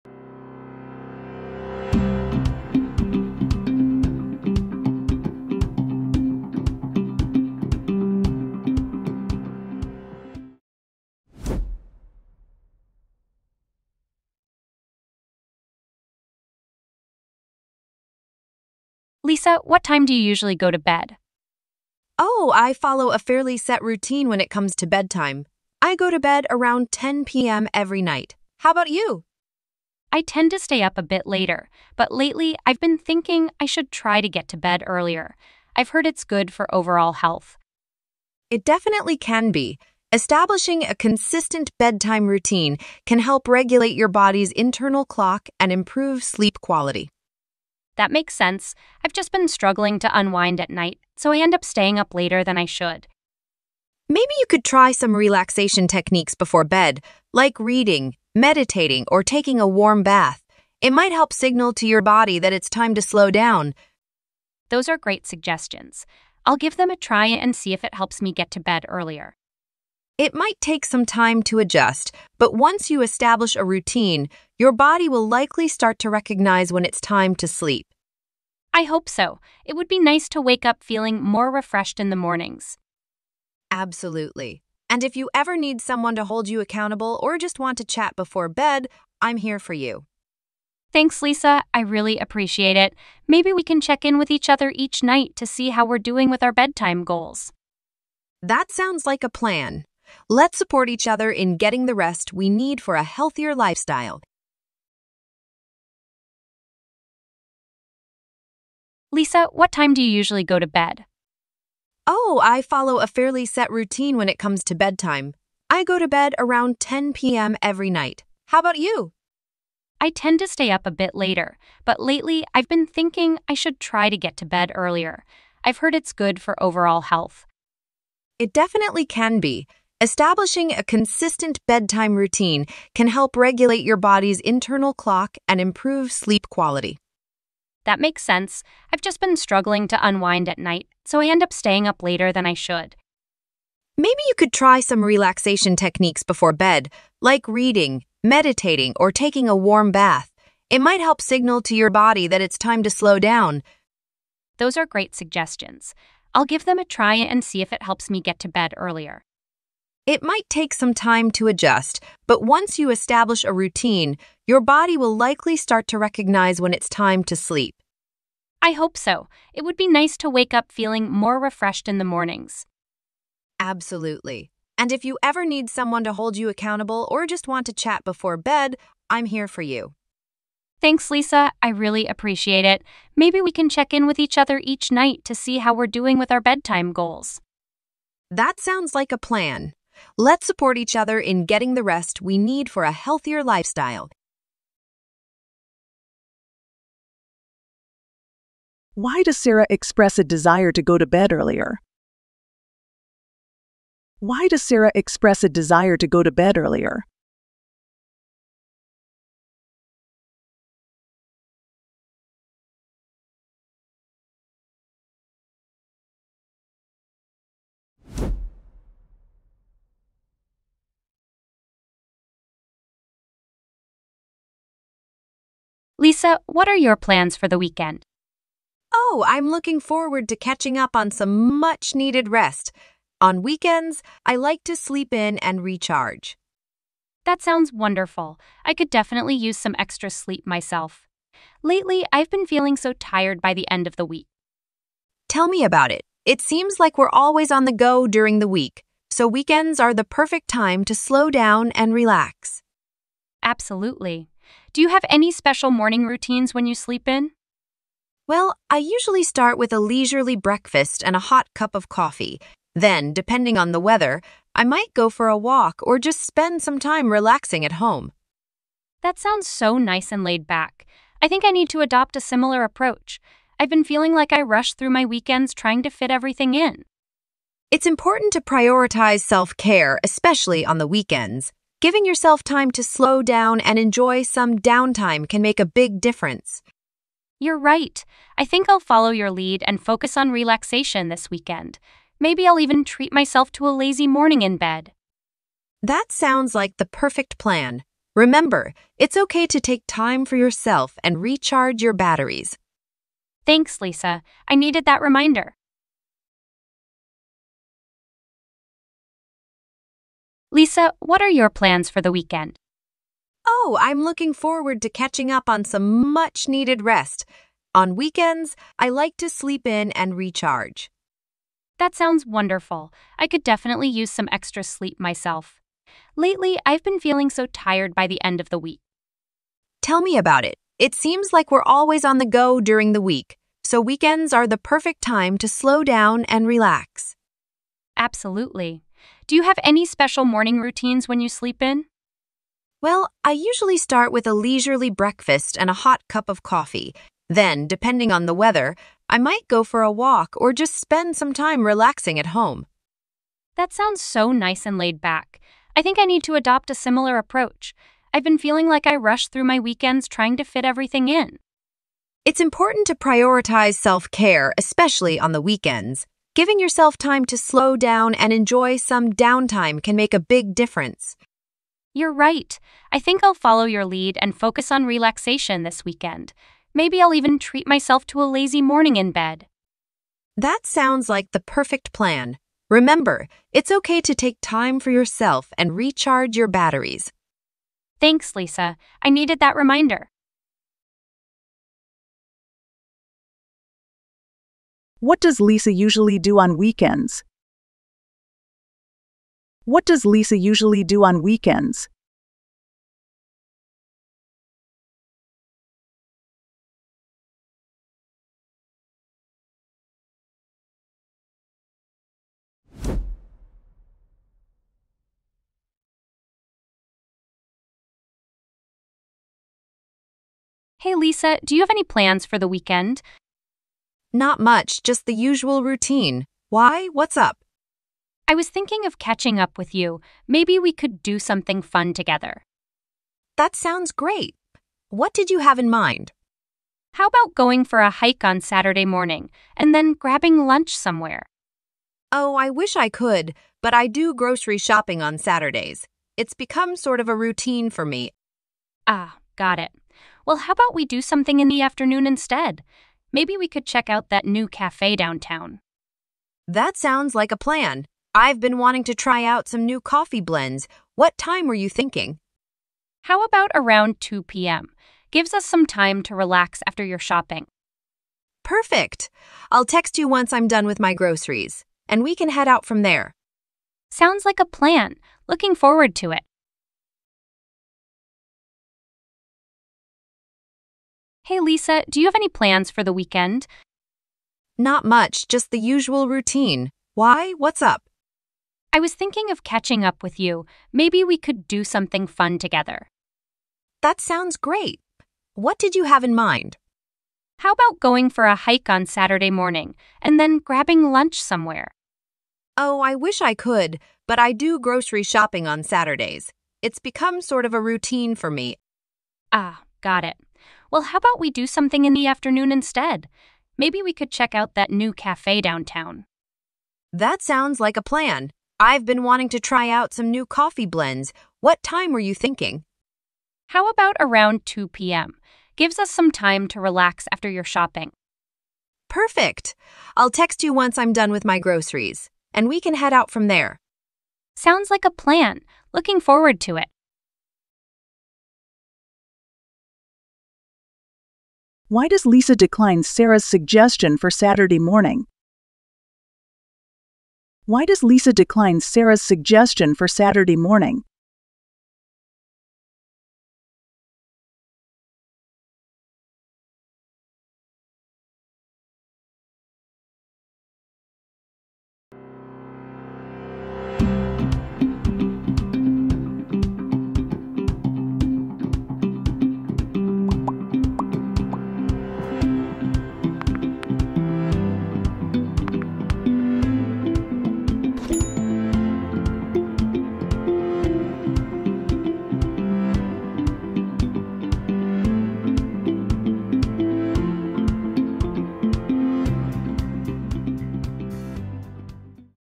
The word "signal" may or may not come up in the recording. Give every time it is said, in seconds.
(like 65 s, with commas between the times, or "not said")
61 s, 151 s.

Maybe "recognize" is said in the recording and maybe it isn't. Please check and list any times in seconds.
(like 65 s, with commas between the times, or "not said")
76 s, 165 s.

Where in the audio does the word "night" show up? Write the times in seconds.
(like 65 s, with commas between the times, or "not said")
28 s, 50 s, 95 s, 117 s, 140 s, 184 s.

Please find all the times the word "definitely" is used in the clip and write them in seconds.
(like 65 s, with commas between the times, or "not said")
38 s, 128 s, 238 s, 323 s.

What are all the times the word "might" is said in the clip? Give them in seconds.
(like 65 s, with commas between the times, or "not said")
60 s, 70 s, 150 s, 160 s, 264 s, 349 s.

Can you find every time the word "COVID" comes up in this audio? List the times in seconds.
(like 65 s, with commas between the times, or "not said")
not said.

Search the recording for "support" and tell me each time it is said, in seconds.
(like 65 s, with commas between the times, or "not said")
100 s, 190 s.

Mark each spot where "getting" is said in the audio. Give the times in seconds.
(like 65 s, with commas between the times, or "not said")
101 s, 191 s.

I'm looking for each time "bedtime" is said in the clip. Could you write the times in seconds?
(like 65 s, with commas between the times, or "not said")
24 s, 41 s, 96 s, 114 s, 131 s, 186 s.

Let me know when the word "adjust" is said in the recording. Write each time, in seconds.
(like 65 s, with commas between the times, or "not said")
71 s, 161 s.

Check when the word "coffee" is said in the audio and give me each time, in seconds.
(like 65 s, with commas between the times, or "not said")
261 s, 346 s, 459 s, 520 s.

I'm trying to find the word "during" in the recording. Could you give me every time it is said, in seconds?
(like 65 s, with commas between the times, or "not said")
248 s, 332 s.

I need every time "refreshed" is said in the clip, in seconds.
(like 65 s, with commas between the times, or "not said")
81 s, 171 s.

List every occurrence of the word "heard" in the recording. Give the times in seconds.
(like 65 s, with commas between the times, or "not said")
35 s, 125 s.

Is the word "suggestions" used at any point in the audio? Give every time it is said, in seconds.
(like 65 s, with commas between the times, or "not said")
65 s, 155 s, 543 s, 549 s.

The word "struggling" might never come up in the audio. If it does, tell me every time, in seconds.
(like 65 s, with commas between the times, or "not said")
49 s, 139 s.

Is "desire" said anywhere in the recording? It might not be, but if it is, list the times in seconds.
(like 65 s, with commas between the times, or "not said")
200 s, 205 s.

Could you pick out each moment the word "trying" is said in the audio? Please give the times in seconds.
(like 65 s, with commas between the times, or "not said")
275 s, 360 s.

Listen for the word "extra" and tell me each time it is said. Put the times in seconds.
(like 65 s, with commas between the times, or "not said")
239 s, 324 s.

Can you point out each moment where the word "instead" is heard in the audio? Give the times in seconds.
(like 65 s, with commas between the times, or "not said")
452 s, 512 s.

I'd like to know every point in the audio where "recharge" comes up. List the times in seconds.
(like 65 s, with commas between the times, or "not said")
235 s, 301 s, 320 s, 385 s.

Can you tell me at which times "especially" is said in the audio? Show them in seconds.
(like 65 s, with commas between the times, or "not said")
280 s, 364 s.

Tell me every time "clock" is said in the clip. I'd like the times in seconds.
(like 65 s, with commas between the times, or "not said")
45 s, 134 s.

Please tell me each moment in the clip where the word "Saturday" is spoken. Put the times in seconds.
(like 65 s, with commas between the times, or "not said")
438 s, 445 s, 498 s, 505 s, 544 s, 549 s.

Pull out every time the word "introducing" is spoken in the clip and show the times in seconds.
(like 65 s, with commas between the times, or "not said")
not said.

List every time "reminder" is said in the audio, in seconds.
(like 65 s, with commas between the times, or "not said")
305 s, 389 s.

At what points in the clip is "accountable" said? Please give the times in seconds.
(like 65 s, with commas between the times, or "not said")
86 s, 176 s.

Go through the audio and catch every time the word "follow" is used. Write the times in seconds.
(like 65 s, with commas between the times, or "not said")
22 s, 112 s, 288 s, 373 s.